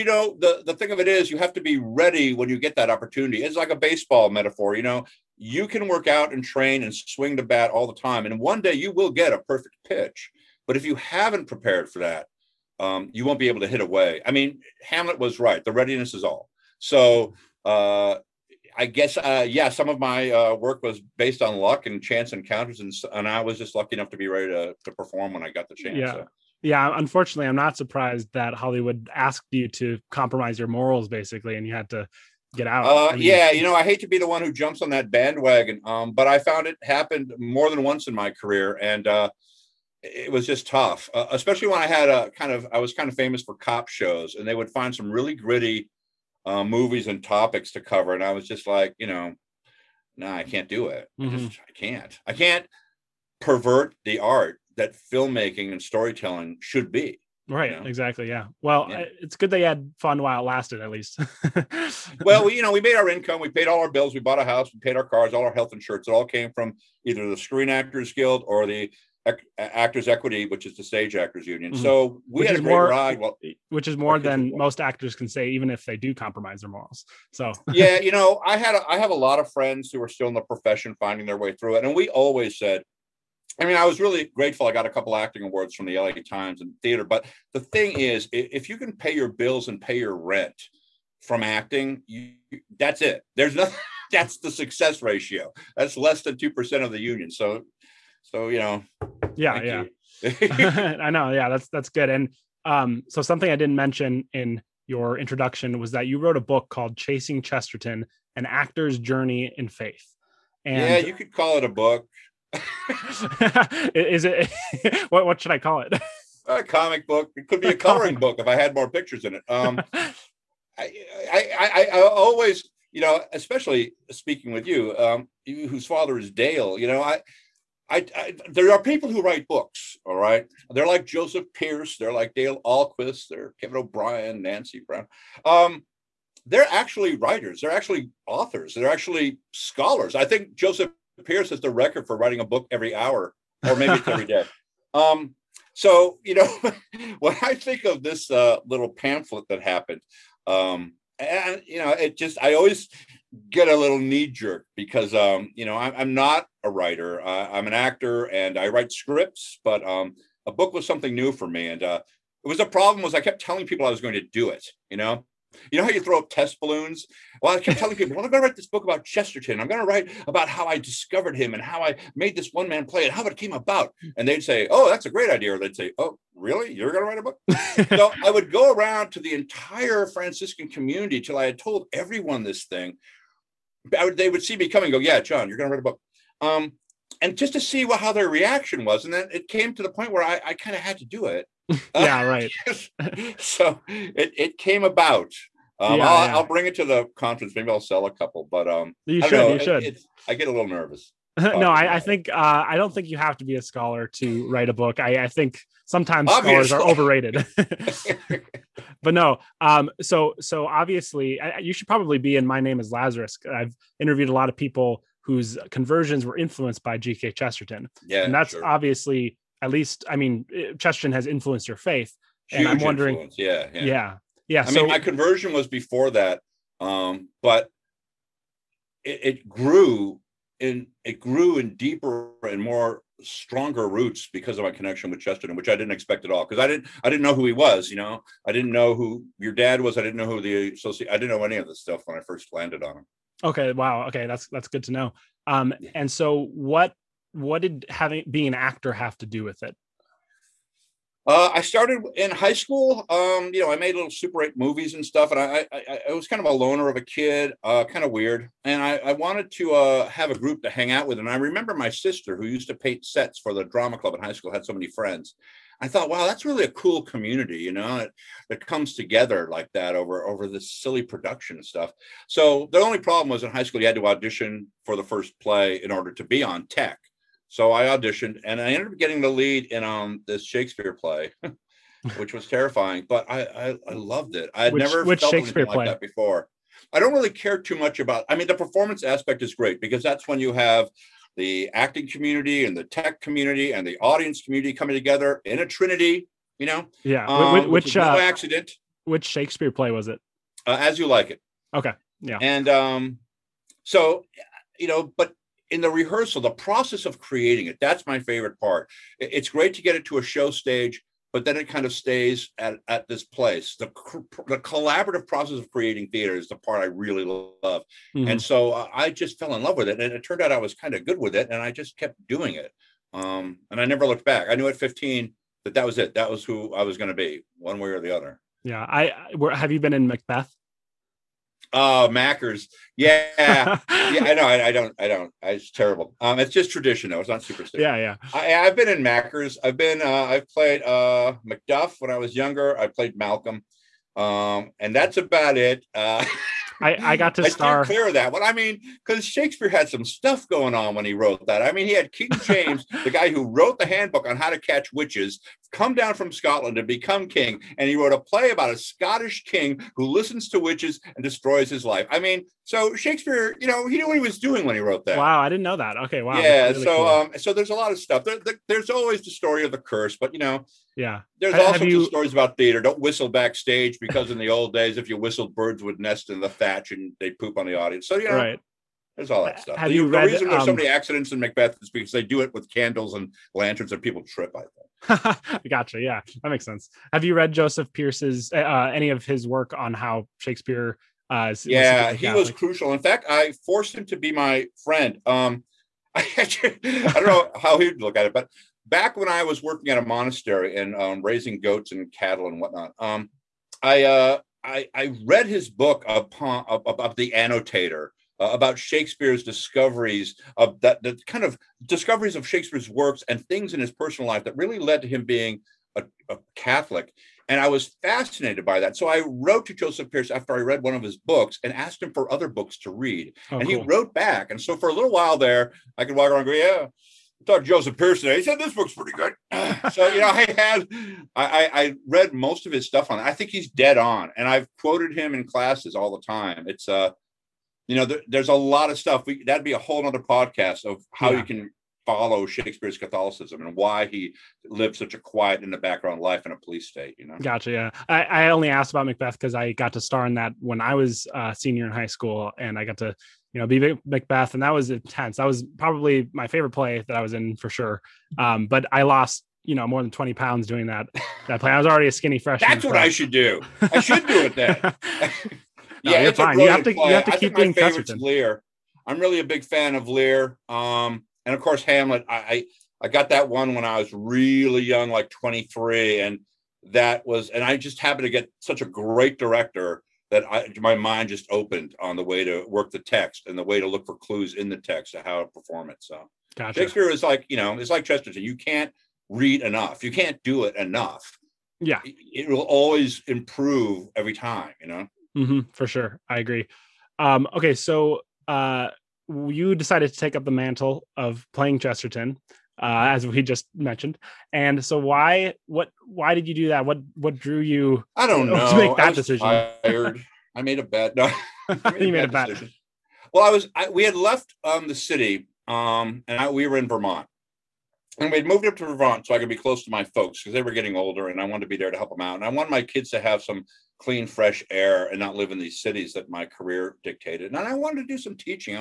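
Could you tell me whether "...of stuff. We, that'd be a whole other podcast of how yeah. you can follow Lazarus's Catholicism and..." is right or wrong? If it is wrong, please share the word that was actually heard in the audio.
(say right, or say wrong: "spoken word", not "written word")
wrong: "Shakespeare", not "Lazarus".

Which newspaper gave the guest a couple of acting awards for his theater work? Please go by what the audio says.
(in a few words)
LA Times.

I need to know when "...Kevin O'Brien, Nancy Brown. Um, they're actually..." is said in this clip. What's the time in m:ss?
2:13.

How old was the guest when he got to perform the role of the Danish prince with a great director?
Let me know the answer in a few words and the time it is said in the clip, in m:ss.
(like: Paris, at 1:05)
23, at 7:55.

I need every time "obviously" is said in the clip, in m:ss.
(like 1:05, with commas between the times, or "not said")
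3:26, 3:30, 3:38.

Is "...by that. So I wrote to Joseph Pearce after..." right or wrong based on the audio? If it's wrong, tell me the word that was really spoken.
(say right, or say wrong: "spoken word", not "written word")
right.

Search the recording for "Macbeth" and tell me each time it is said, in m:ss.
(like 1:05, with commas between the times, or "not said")
5:30, 6:21, 7:29, 7:34.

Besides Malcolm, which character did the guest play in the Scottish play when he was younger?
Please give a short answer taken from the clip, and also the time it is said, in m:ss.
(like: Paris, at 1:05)
Macduff, at 5:41.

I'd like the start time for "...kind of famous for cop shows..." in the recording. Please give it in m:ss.
0:42.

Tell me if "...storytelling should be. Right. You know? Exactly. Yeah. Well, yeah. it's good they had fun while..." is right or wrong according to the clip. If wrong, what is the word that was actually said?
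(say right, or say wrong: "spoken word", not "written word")
right.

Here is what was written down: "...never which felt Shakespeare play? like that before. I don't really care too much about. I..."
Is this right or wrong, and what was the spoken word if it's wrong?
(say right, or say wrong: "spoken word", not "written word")
right.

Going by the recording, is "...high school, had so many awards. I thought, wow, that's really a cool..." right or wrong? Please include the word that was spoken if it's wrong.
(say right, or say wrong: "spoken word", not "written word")
wrong: "friends", not "awards".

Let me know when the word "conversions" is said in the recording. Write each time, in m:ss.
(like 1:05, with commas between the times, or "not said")
3:35, 3:44.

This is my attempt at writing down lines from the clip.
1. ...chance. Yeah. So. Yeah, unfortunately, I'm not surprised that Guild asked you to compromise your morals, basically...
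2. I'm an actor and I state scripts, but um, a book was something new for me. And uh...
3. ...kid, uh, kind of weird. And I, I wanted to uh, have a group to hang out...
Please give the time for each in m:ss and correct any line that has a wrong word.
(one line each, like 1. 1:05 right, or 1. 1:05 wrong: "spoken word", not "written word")
1. 0:25 wrong: "Hollywood", not "Guild"
2. 2:37 wrong: "write", not "state"
3. 4:17 right.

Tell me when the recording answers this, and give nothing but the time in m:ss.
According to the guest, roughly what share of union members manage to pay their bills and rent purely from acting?
1:35.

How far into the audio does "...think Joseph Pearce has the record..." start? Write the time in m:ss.
2:20.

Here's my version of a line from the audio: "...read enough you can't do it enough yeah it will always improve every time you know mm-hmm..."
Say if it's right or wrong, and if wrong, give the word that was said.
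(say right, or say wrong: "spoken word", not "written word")
right.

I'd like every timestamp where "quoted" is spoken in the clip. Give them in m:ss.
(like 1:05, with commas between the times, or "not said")
7:14.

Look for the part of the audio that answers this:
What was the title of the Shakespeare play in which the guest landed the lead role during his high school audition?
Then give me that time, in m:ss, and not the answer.
5:00.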